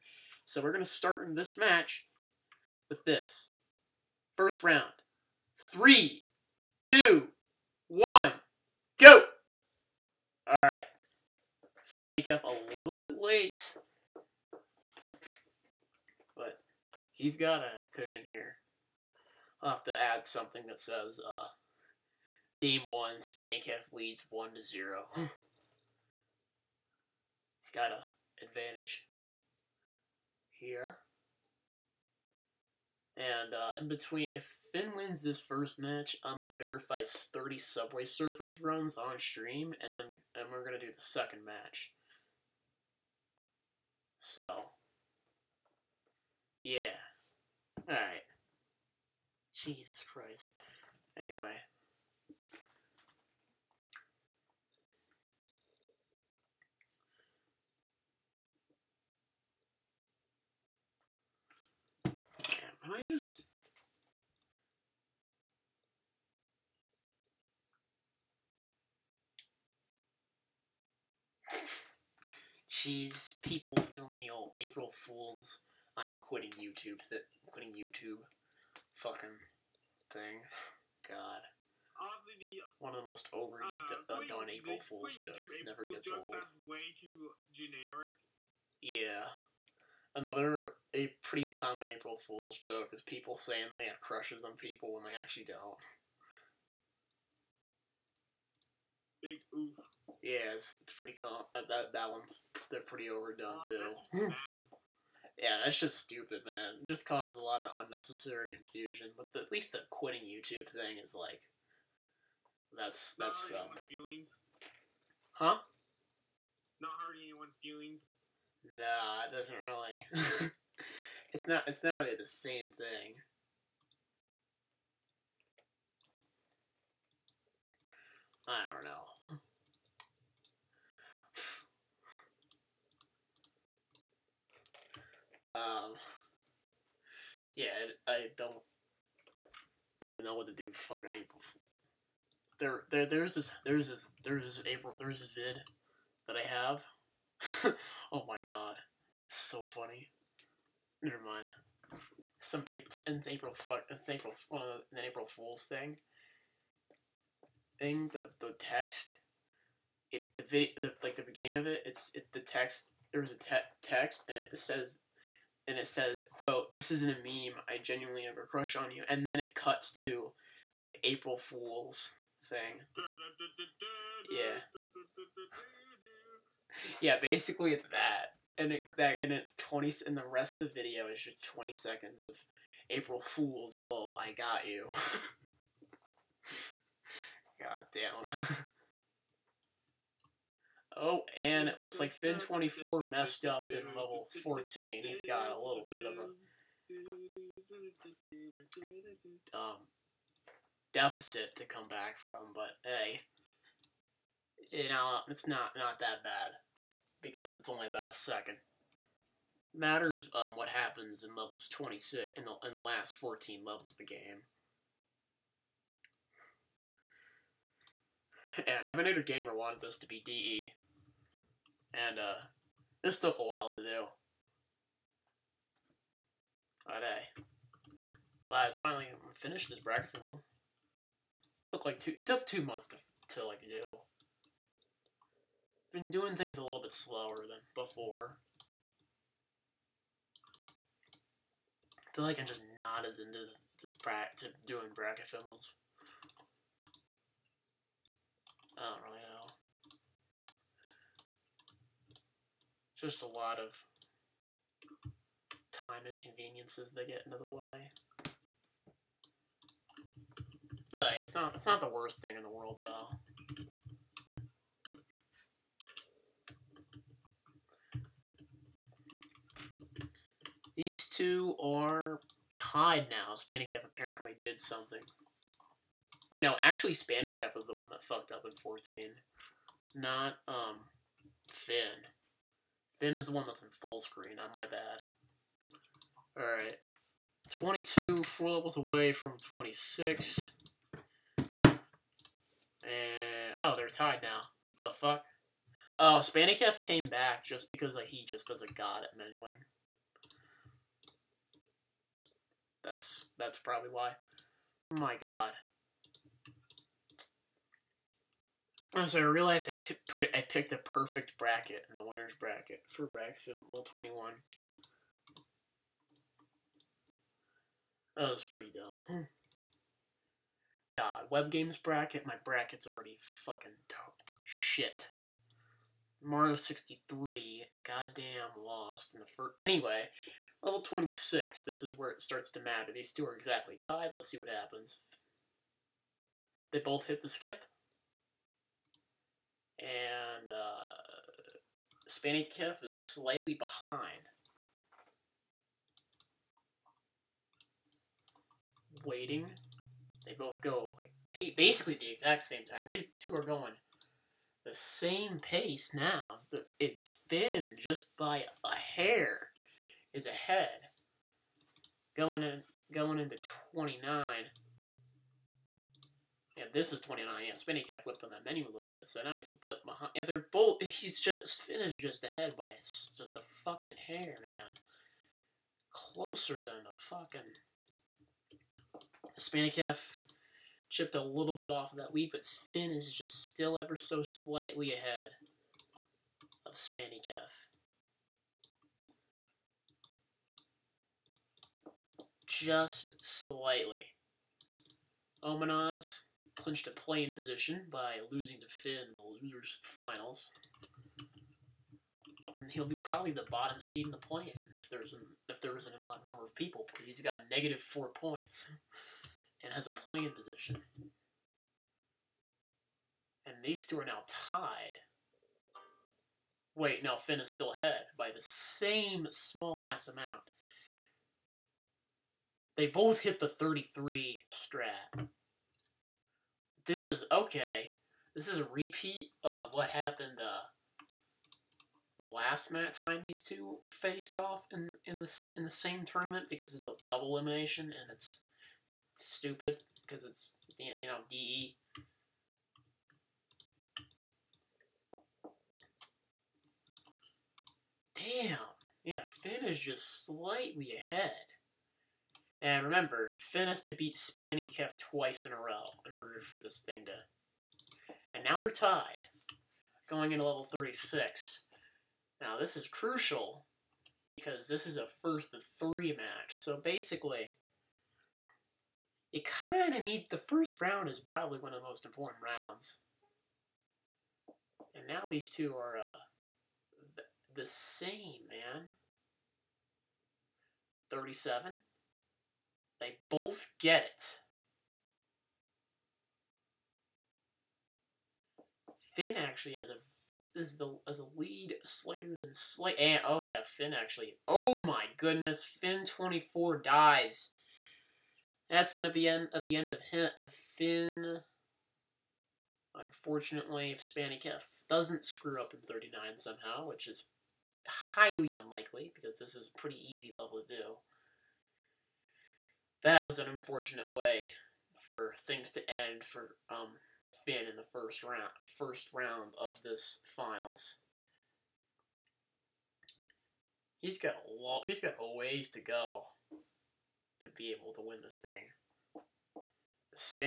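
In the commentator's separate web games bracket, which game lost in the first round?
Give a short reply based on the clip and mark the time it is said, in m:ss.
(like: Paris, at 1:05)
Mario 63, at 5:26.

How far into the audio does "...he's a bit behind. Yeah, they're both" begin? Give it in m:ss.
6:09.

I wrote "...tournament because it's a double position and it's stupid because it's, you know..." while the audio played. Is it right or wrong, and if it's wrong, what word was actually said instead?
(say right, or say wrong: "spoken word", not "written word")
wrong: "elimination", not "position".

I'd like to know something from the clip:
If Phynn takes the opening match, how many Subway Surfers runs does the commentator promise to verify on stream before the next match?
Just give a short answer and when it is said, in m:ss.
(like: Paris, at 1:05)
30, at 0:37.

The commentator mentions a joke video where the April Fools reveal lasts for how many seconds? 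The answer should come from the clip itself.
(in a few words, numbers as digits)
20.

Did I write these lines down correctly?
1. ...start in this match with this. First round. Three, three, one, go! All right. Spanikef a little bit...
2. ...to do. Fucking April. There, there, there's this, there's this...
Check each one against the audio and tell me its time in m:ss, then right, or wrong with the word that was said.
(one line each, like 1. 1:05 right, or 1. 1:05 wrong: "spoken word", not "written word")
1. 0:00 wrong: "two", not "three"
2. 2:20 right.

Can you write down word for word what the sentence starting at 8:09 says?
Phynn actually has a is the as a lead slighter than slight.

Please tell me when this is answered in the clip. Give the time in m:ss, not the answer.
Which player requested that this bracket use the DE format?
3:38.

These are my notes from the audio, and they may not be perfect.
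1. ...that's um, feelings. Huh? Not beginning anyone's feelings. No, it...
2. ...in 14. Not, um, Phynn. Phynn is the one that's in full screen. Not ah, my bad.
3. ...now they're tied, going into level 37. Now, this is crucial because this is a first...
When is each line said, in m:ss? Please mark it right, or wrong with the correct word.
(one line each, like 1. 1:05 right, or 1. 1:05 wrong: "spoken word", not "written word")
1. 1:53 wrong: "hurting", not "beginning"
2. 4:38 right
3. 7:38 wrong: "36", not "37".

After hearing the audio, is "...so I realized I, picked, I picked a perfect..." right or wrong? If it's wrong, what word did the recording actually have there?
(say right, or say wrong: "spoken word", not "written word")
right.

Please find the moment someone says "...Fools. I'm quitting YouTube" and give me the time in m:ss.
1:14.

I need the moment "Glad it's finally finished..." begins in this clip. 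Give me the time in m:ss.
3:48.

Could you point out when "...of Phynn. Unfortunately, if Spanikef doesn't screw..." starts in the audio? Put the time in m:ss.
8:20.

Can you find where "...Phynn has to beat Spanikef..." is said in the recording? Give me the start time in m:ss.
7:33.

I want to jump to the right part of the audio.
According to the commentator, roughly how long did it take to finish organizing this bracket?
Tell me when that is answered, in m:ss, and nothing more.
3:52.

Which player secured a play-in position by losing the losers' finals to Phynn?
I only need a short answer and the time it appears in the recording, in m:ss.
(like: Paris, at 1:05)
Omanaz, at 6:35.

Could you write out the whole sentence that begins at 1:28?
Yeah another a pretty common April Fool's joke is people saying they have crushes on people when they actually don't.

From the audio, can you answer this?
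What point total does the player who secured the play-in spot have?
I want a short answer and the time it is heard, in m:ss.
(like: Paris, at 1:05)
-4, at 6:47.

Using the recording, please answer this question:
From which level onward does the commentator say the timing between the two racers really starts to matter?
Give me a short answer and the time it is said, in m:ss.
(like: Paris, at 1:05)
26, at 5:30.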